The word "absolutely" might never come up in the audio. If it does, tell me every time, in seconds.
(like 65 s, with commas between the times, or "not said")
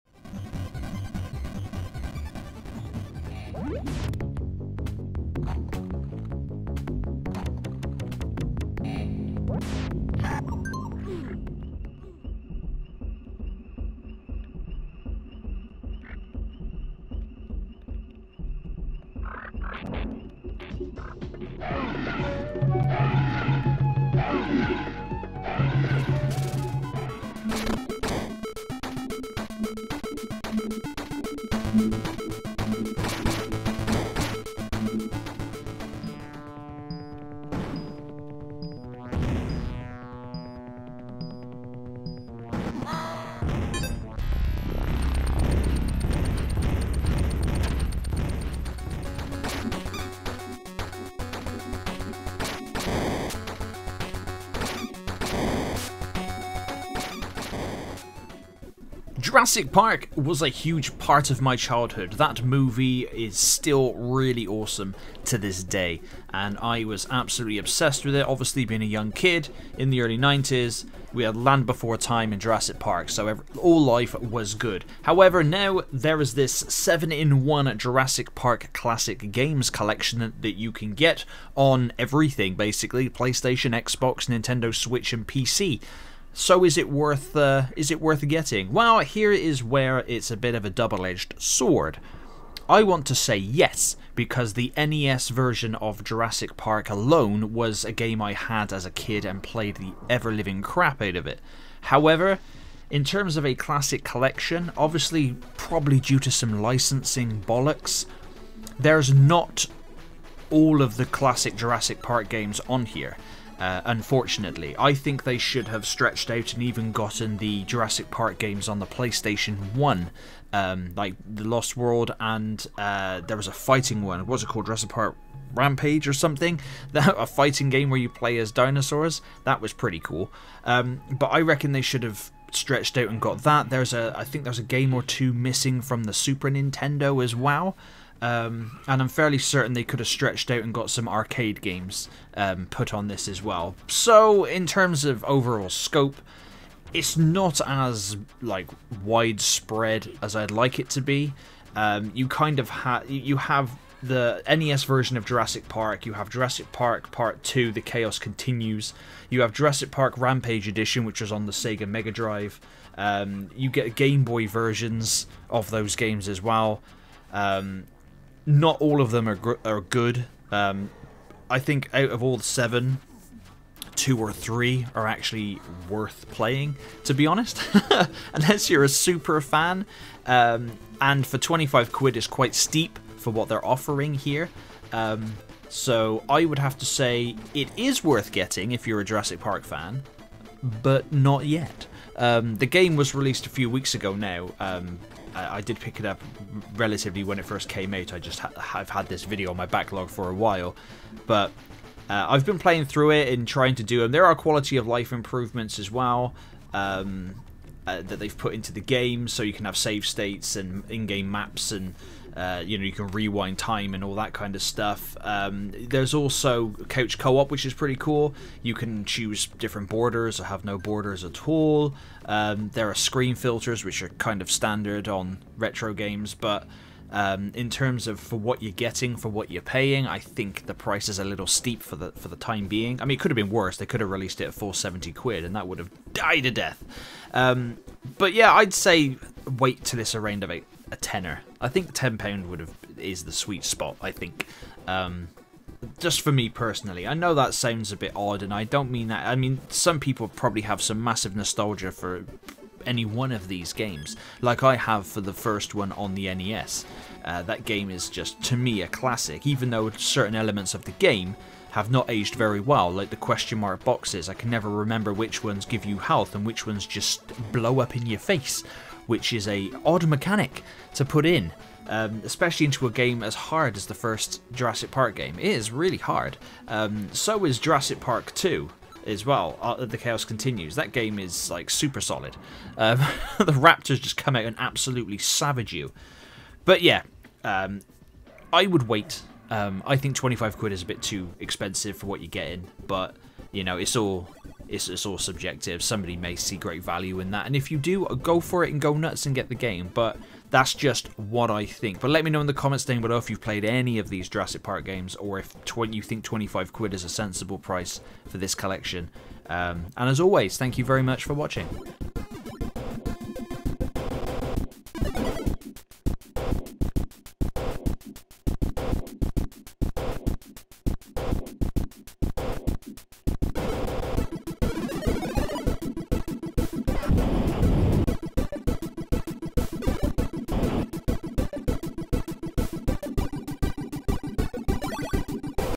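67 s, 284 s.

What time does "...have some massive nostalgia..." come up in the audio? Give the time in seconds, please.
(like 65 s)
250 s.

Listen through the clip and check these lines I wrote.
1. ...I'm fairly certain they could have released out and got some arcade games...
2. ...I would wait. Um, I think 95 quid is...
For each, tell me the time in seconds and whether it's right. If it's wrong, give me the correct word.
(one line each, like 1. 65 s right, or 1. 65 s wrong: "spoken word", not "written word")
1. 139 s wrong: "stretched", not "released"
2. 288 s wrong: "25", not "95".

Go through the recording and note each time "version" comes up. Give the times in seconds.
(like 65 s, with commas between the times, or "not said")
95 s, 154 s, 164 s.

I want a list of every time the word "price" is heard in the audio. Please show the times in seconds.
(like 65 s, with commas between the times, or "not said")
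230 s, 307 s.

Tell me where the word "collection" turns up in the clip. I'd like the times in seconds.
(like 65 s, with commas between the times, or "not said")
79 s, 104 s, 308 s.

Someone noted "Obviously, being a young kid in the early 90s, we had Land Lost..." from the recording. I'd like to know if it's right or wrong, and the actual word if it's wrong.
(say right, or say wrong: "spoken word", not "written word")
wrong: "Before", not "Lost".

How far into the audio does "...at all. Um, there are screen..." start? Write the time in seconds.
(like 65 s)
221 s.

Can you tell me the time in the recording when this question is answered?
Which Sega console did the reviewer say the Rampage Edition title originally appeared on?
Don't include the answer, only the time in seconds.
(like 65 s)
161 s.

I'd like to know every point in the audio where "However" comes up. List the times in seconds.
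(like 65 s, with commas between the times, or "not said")
75 s, 101 s.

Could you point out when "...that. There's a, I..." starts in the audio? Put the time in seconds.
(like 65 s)
133 s.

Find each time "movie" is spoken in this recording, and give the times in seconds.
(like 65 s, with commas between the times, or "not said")
62 s.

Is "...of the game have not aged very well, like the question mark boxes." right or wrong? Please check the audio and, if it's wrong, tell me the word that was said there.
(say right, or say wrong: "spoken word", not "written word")
right.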